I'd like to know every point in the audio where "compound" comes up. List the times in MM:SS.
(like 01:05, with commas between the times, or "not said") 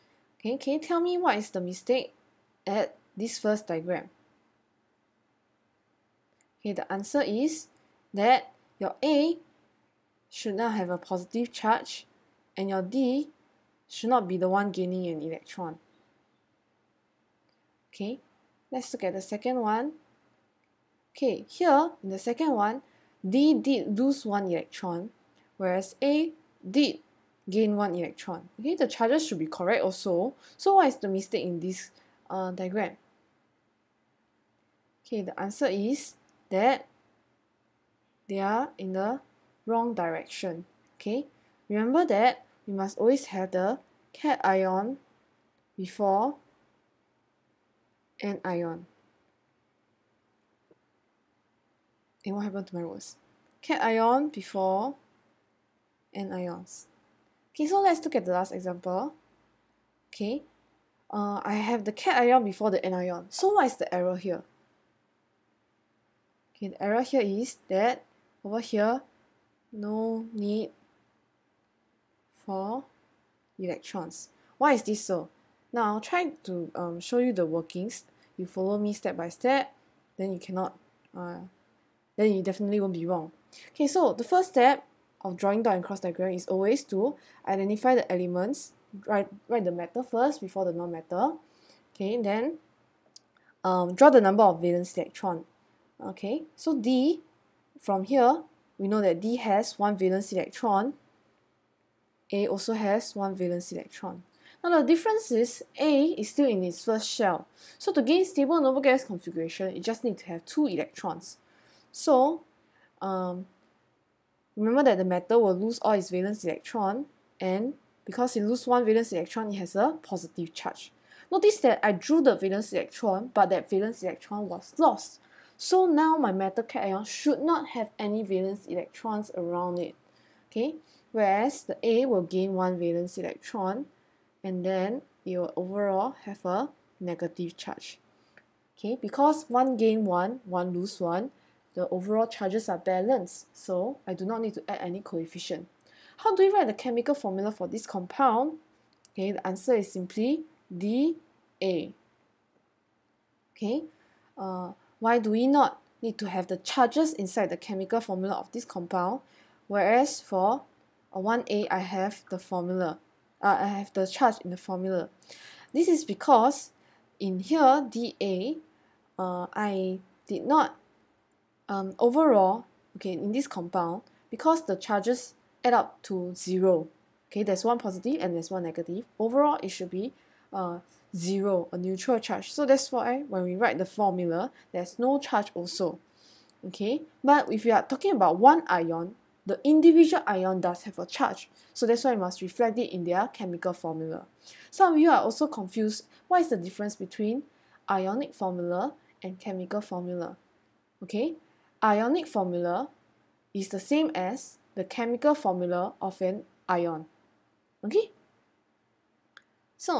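02:27, 02:38, 02:53.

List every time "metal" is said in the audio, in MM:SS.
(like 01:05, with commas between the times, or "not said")
01:55, 02:06.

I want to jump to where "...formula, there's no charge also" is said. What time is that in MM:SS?
03:03.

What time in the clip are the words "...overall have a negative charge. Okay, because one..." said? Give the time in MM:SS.
02:15.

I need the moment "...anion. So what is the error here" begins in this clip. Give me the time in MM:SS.
01:02.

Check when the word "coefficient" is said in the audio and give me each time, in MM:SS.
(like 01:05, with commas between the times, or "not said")
02:24.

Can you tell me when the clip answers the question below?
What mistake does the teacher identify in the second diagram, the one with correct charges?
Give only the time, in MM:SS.
00:38.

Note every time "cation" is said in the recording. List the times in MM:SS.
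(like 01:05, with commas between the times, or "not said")
00:44, 00:53, 01:01, 02:06.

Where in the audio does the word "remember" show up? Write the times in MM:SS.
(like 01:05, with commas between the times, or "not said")
00:41, 01:54.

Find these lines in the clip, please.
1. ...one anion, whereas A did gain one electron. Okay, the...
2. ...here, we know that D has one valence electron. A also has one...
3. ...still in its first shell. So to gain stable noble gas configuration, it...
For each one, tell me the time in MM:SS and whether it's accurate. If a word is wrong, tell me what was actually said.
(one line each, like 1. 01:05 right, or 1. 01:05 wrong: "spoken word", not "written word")
1. 00:24 wrong: "electron", not "anion"
2. 01:38 right
3. 01:46 right.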